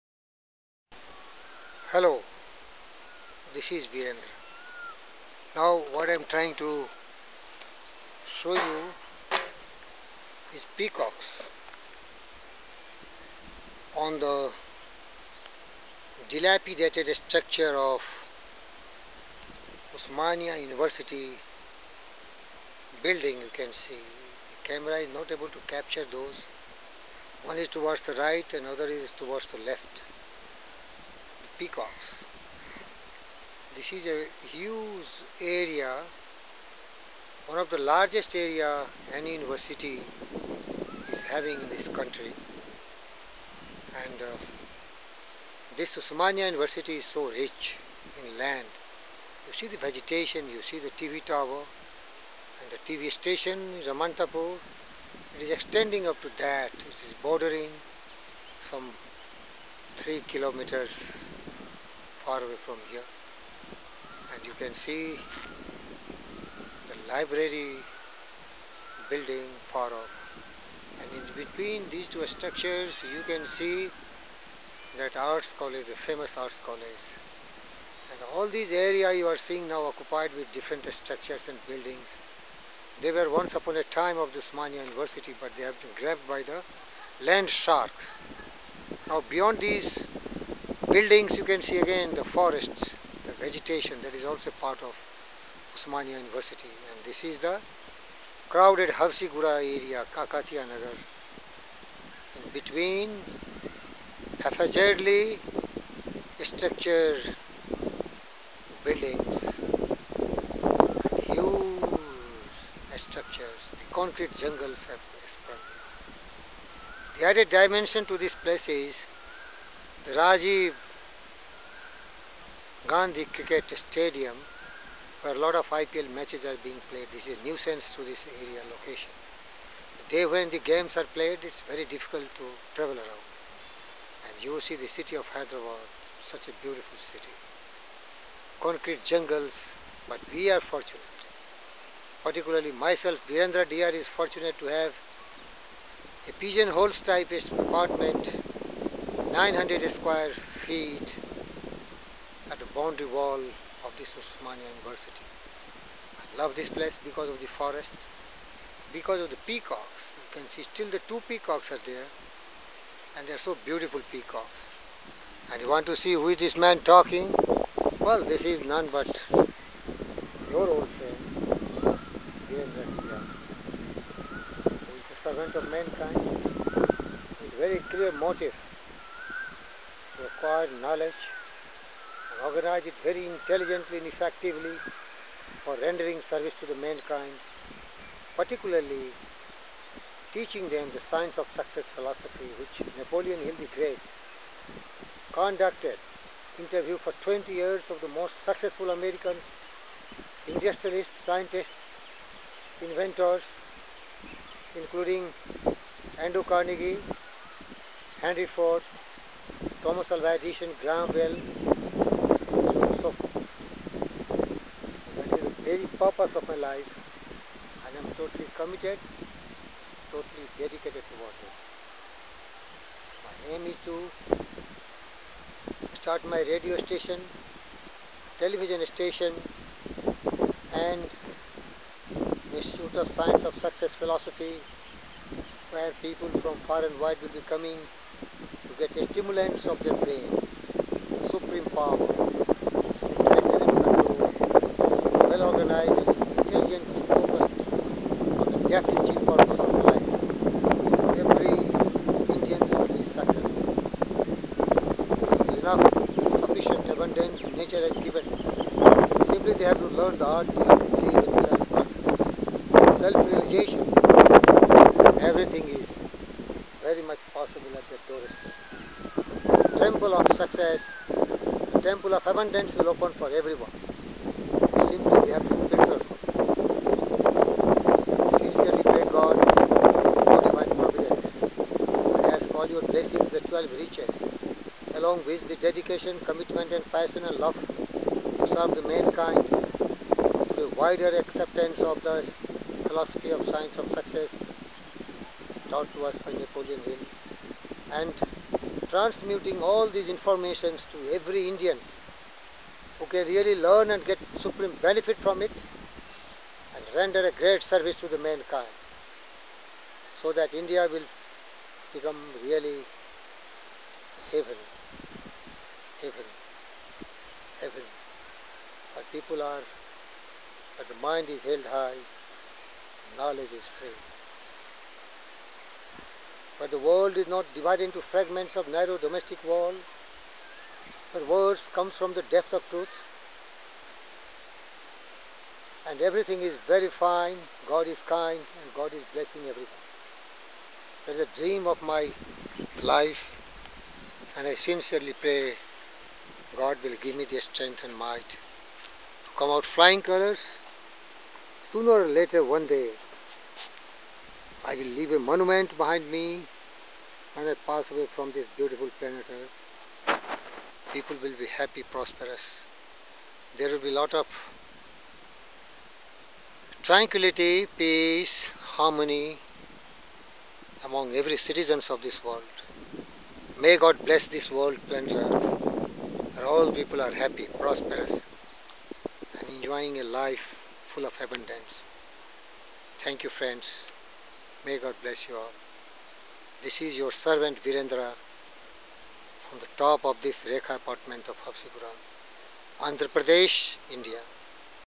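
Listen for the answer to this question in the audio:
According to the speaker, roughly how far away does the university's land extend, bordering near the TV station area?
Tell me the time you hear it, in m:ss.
0:59.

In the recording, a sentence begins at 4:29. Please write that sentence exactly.
temple of success, the temple of abundance will open for everyone.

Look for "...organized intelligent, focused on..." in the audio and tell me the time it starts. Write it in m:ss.
4:05.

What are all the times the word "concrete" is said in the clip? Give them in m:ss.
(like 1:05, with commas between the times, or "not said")
1:53, 2:18.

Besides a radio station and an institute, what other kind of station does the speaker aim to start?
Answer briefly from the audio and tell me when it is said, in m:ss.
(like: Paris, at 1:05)
television station, at 3:48.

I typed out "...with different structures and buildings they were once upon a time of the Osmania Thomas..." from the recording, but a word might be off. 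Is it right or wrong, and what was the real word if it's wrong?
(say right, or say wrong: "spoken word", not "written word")
wrong: "University", not "Thomas".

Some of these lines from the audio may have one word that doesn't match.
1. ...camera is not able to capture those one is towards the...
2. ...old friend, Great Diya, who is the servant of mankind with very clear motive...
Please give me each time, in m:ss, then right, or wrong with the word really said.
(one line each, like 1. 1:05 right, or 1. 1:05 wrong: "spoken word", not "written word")
1. 0:24 right
2. 2:50 wrong: "Virendra", not "Great".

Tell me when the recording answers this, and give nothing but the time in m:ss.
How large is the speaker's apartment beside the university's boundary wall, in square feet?
2:29.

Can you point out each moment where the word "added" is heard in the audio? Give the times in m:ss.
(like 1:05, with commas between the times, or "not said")
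1:57.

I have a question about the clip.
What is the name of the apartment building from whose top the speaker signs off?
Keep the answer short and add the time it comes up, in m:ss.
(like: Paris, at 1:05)
Rekha apartment, at 6:30.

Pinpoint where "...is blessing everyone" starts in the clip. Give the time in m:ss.
5:38.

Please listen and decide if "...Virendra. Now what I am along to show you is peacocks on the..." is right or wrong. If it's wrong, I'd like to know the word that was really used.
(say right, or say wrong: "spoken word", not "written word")
wrong: "trying", not "along".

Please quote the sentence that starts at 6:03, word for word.
There will be a lot of tranquility, peace, harmony among every citizens of this world.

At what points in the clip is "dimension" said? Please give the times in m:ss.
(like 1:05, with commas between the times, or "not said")
1:57.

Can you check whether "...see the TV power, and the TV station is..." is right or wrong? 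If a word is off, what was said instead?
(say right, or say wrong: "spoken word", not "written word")
wrong: "tower", not "power".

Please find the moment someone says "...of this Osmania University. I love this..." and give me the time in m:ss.
2:33.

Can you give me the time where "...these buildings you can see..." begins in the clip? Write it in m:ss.
1:29.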